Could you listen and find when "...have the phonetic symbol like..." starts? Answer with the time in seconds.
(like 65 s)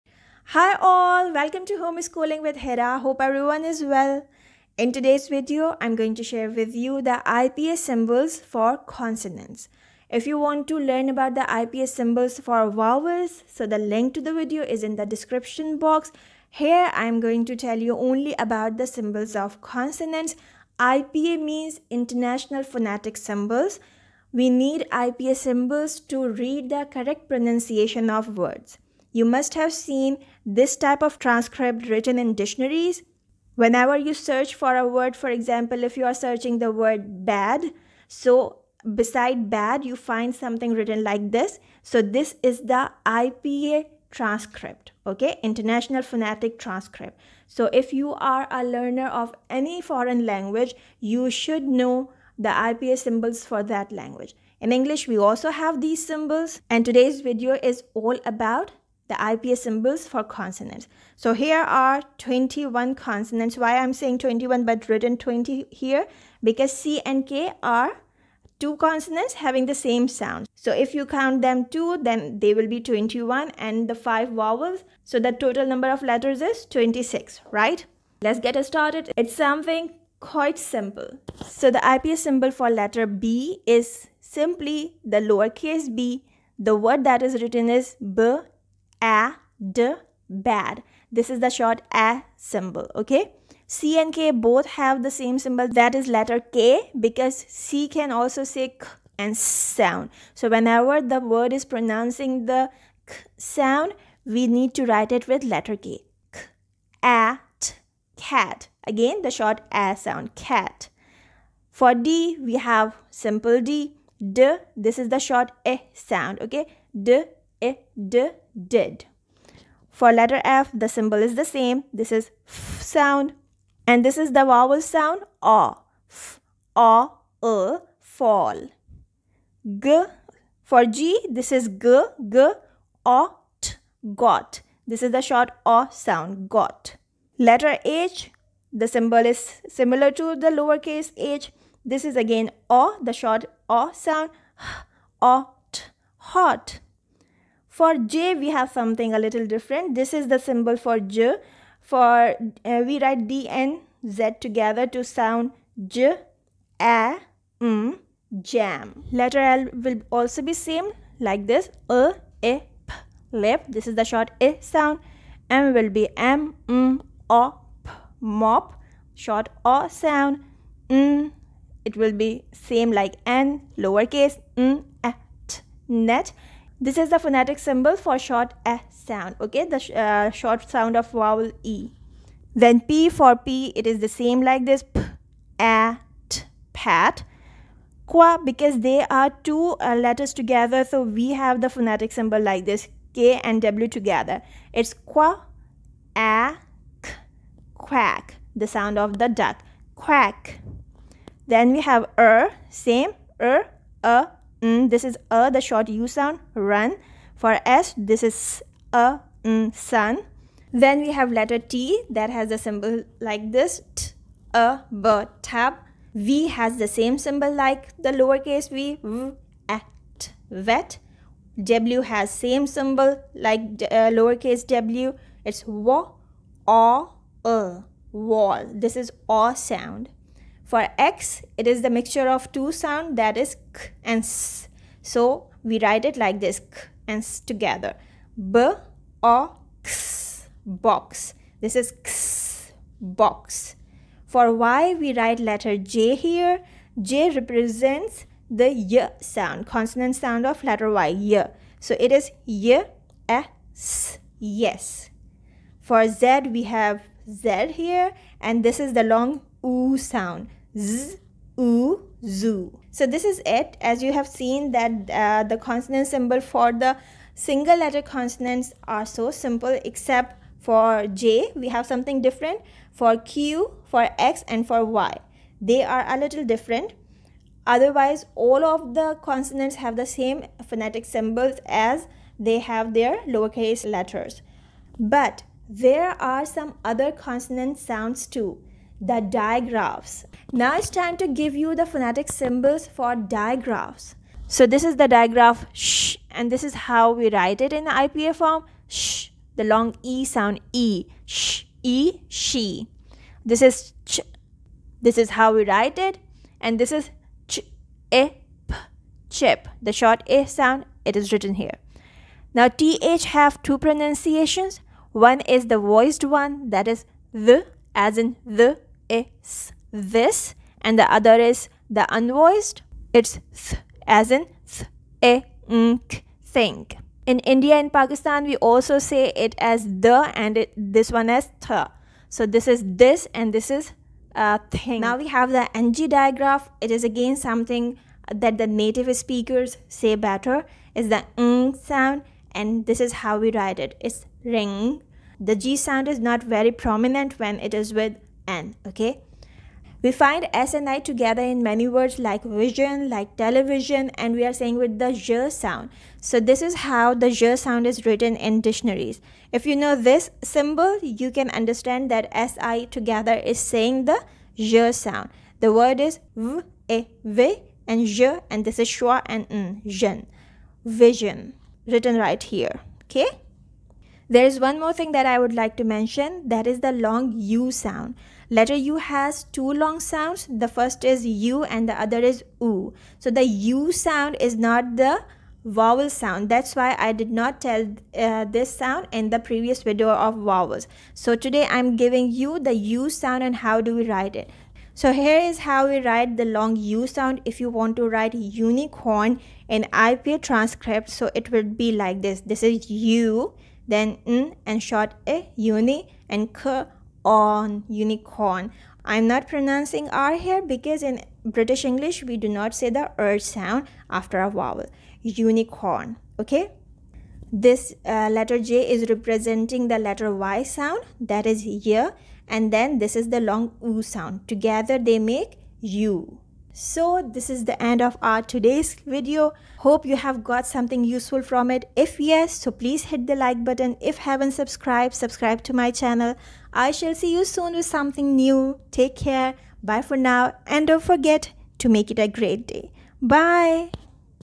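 191 s.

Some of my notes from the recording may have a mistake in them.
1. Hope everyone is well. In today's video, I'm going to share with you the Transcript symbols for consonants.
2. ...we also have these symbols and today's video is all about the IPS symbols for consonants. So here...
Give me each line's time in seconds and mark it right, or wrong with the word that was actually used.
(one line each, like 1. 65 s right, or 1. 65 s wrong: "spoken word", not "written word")
1. 2 s wrong: "IPS", not "Transcript"
2. 55 s right.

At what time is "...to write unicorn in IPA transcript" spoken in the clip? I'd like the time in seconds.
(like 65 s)
397 s.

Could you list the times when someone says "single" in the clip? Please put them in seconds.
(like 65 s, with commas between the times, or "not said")
267 s.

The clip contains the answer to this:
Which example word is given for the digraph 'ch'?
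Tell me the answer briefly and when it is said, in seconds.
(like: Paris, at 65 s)
chip, at 309 s.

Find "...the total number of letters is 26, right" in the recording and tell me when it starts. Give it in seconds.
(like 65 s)
75 s.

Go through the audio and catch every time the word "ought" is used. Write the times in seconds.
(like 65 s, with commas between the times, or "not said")
133 s, 145 s.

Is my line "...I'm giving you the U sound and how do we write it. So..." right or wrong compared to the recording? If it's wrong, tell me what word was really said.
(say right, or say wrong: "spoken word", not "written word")
right.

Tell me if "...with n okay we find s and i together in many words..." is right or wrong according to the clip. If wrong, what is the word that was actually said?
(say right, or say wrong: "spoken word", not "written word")
right.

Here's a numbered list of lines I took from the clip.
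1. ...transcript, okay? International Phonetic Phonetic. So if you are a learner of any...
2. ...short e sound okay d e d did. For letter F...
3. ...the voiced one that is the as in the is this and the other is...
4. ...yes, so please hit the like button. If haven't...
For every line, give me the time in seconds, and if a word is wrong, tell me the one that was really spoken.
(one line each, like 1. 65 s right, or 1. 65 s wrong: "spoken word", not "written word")
1. 44 s wrong: "Transcript", not "Phonetic"
2. 115 s right
3. 315 s right
4. 432 s right.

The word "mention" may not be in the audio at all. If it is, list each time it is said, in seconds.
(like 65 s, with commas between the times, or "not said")
375 s.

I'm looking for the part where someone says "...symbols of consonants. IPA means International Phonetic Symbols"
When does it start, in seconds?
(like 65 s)
18 s.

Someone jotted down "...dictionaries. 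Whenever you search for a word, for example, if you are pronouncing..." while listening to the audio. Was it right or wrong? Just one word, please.
wrong.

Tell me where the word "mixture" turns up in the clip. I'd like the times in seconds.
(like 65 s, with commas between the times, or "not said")
231 s.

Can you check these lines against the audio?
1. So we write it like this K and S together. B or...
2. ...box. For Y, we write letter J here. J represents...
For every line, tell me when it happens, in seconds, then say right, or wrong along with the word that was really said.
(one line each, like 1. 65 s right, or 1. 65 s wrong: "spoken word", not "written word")
1. 235 s right
2. 243 s right.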